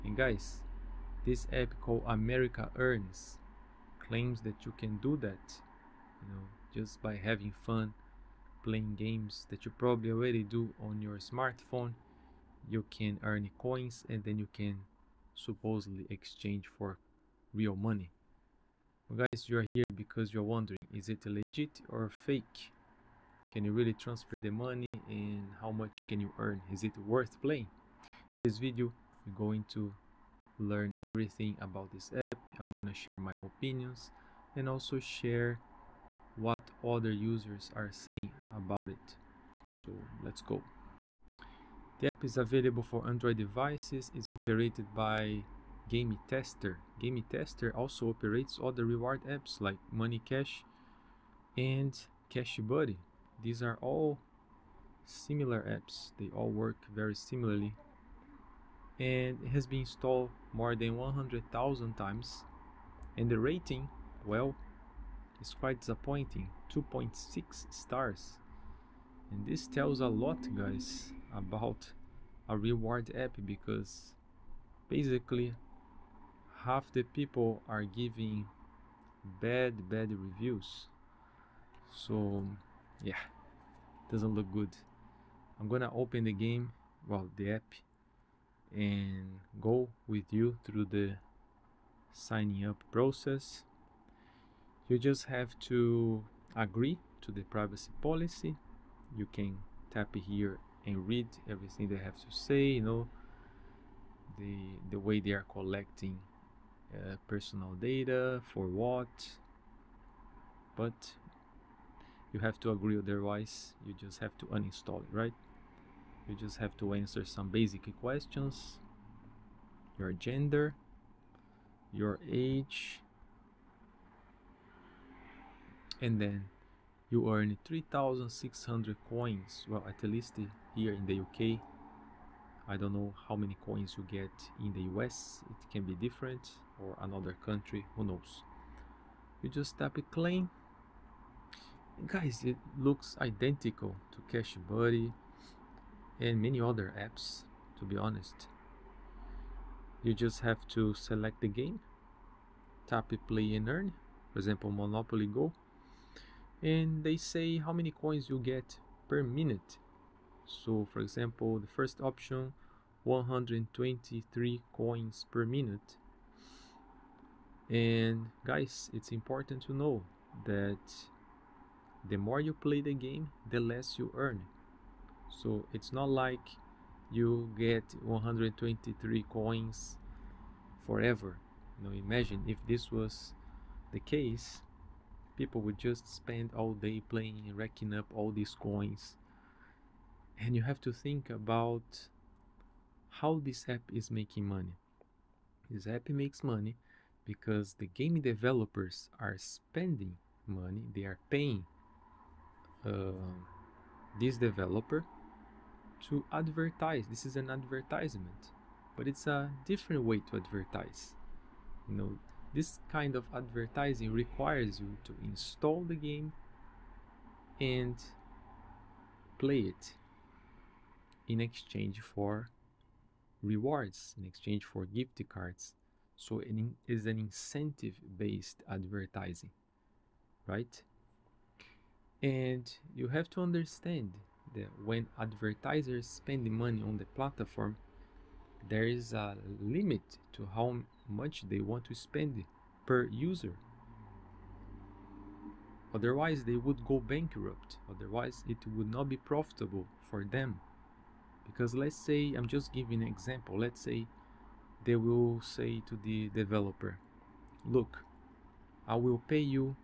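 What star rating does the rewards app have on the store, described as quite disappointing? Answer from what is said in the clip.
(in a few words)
2.6 stars.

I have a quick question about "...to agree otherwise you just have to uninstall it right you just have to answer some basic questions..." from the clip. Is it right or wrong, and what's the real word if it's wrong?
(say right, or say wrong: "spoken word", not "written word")
right.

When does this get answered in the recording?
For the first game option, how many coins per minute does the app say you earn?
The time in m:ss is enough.
2:43.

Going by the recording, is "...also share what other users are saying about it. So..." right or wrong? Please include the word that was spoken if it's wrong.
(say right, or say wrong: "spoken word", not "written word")
right.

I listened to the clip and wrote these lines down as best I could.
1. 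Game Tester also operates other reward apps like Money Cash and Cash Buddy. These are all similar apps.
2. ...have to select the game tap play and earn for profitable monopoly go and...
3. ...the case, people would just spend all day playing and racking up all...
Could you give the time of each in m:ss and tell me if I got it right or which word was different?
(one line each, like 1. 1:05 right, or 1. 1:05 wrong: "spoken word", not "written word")
1. 0:47 right
2. 2:30 wrong: "example", not "profitable"
3. 3:03 right.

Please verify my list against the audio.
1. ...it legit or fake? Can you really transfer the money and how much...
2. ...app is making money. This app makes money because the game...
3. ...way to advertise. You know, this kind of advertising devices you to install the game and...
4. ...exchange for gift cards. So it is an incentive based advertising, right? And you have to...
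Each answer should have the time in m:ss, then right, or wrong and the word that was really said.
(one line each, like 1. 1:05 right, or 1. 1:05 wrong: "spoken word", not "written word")
1. 0:21 right
2. 3:13 right
3. 3:30 wrong: "requires", not "devices"
4. 3:44 right.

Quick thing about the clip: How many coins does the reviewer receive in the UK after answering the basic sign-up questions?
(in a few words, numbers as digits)
3600.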